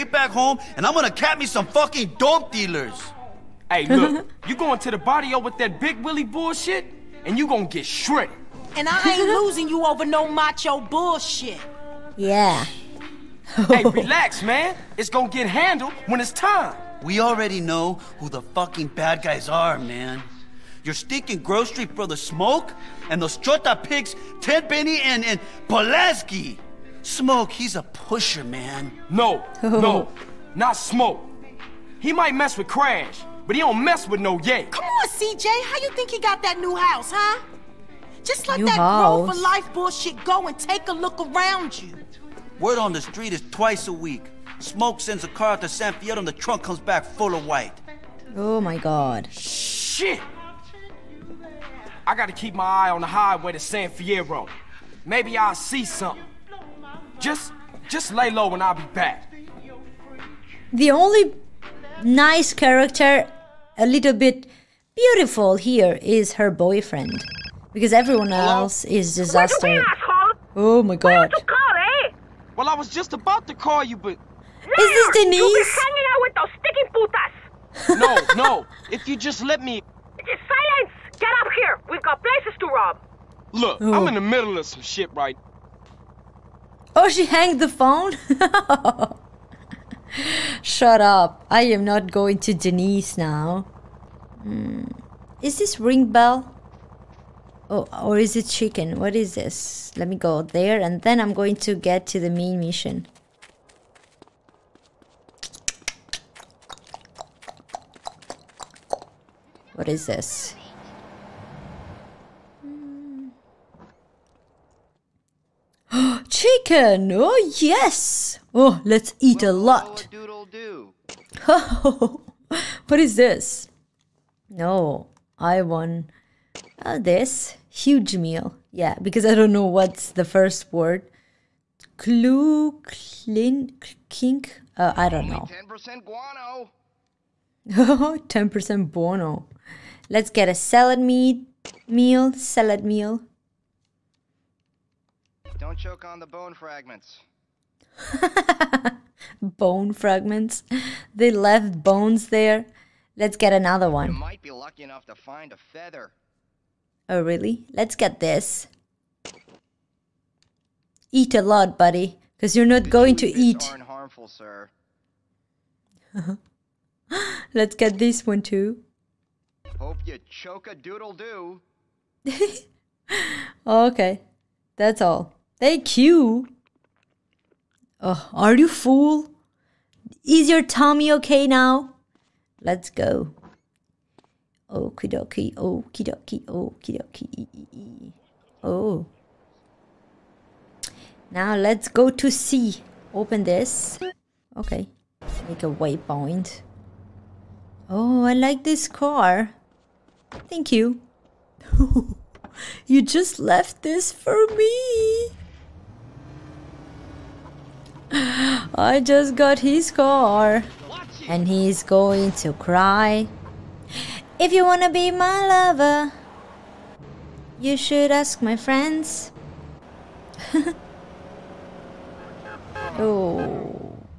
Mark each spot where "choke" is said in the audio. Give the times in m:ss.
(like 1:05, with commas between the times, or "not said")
2:25, 2:50.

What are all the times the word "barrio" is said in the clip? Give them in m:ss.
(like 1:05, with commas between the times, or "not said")
0:04.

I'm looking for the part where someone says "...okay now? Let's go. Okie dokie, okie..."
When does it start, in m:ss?
3:01.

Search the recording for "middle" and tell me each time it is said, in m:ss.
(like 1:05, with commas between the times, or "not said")
1:24.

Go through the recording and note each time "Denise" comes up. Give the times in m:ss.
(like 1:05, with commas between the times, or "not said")
1:15, 1:32.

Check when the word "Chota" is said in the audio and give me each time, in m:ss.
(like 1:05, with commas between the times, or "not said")
0:23.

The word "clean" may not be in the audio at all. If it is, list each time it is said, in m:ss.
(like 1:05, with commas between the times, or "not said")
2:12.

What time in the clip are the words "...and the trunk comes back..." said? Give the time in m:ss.
0:46.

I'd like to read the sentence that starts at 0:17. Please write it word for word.
We already know who the fucking bad guys are, man.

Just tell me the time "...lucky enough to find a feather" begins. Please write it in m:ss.
2:34.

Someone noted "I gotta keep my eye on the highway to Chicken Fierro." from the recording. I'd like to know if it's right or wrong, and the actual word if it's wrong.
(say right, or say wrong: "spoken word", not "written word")
wrong: "San", not "Chicken".